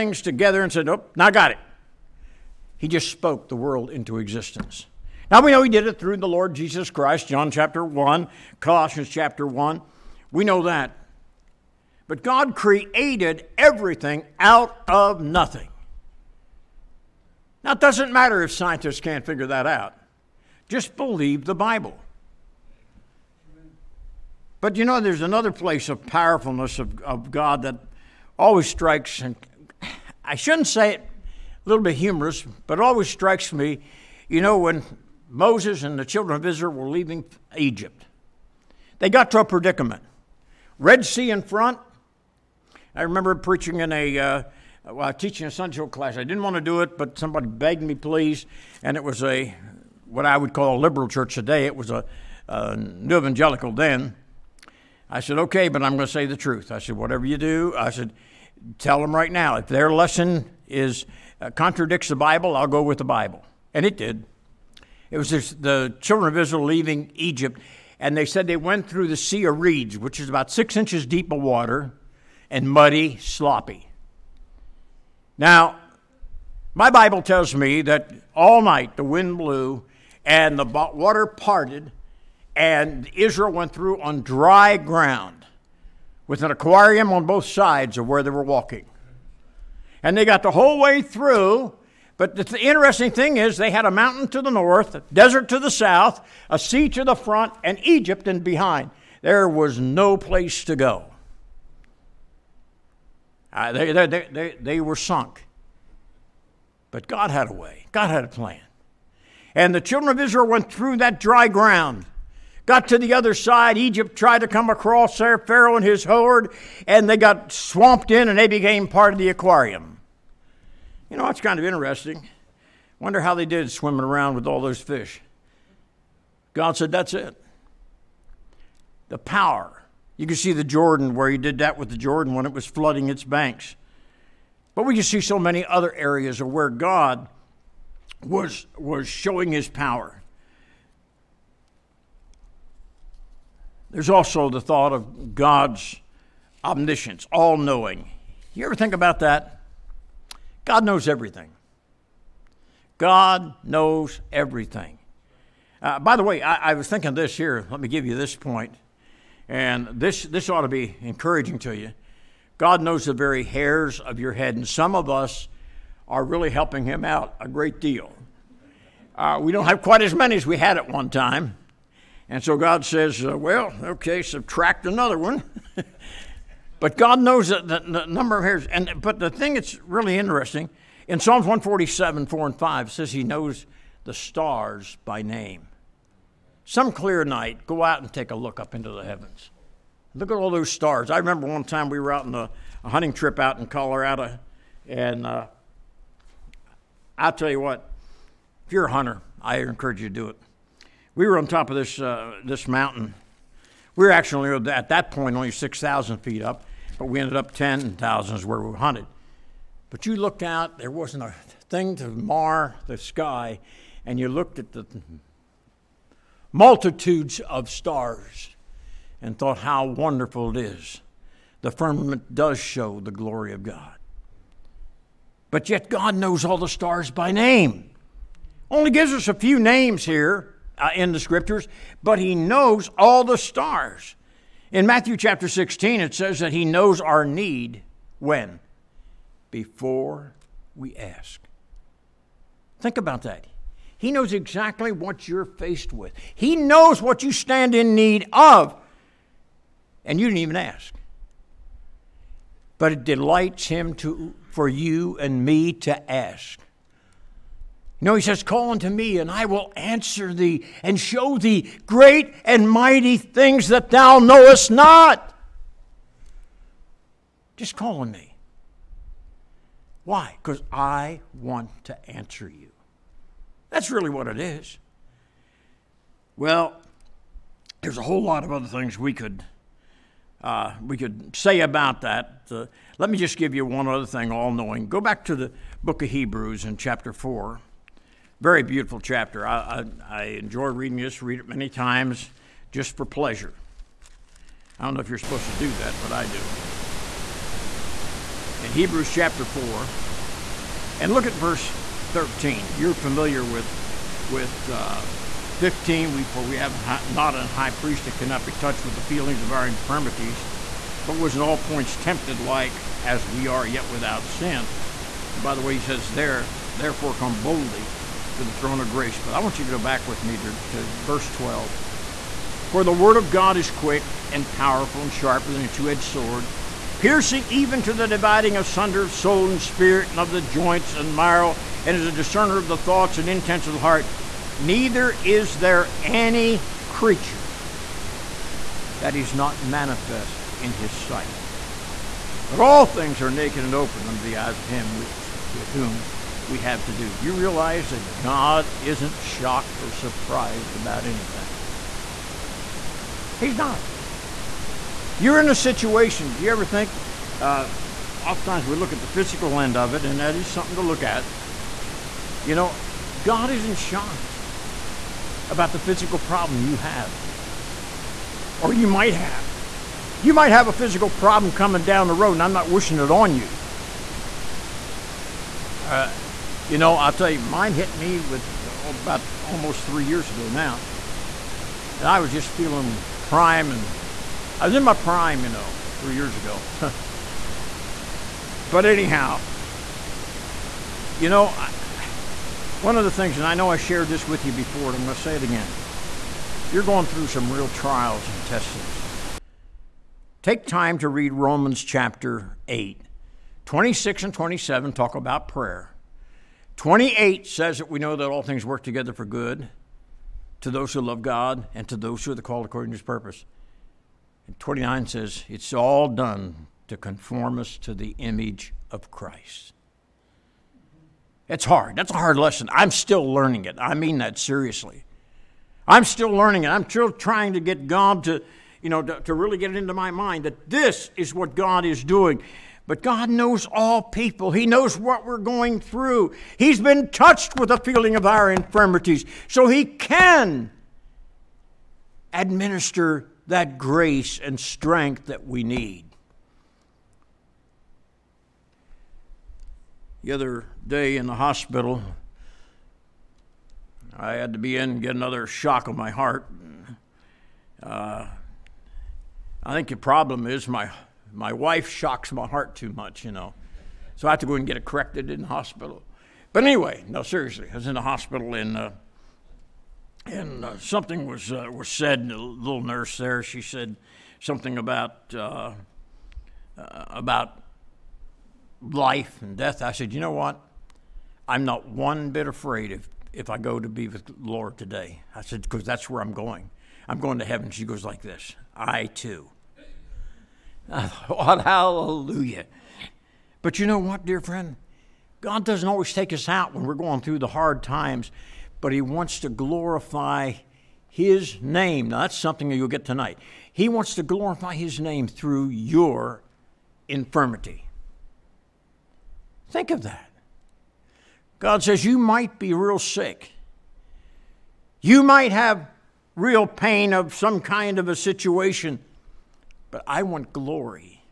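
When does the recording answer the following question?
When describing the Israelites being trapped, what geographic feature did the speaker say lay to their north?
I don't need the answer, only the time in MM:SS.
01:33.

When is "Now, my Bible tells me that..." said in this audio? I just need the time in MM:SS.
01:15.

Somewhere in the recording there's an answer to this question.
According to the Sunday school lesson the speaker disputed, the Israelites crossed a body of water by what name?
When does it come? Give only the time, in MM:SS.
01:09.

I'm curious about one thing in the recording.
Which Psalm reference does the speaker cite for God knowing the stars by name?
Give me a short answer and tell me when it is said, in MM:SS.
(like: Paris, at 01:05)
Psalms 147:4-5, at 03:01.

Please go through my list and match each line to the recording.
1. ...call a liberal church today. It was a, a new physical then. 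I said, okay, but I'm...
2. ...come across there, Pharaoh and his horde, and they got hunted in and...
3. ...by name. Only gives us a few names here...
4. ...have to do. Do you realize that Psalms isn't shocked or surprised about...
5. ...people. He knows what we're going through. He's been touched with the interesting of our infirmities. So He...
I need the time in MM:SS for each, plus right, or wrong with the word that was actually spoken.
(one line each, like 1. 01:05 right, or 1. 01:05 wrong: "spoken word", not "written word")
1. 00:50 wrong: "evangelical", not "physical"
2. 01:54 wrong: "swamped", not "hunted"
3. 03:47 right
4. 05:46 wrong: "God", not "Psalms"
5. 07:14 wrong: "feeling", not "interesting".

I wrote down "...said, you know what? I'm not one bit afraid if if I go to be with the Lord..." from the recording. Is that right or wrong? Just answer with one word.
right.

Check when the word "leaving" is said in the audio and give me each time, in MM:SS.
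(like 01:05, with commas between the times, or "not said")
00:36, 01:06.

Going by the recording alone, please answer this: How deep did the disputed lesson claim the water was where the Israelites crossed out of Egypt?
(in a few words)
six inches.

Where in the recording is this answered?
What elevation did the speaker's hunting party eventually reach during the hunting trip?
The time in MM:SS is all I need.
03:27.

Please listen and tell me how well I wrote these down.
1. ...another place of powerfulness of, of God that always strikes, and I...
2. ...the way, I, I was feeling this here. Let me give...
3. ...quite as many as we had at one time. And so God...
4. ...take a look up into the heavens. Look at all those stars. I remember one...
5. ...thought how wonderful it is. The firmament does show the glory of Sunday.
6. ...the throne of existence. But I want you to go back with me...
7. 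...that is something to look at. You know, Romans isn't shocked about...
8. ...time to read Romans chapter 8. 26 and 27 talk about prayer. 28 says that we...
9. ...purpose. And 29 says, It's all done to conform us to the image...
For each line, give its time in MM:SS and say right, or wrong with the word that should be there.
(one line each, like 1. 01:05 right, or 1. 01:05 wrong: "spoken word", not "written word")
1. 00:25 right
2. 02:36 wrong: "thinking", not "feeling"
3. 02:49 right
4. 03:08 right
5. 03:39 wrong: "God", not "Sunday"
6. 05:18 wrong: "grace", not "existence"
7. 06:00 wrong: "God", not "Romans"
8. 06:40 right
9. 06:53 right.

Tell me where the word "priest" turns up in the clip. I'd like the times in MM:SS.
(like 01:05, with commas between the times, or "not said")
05:07.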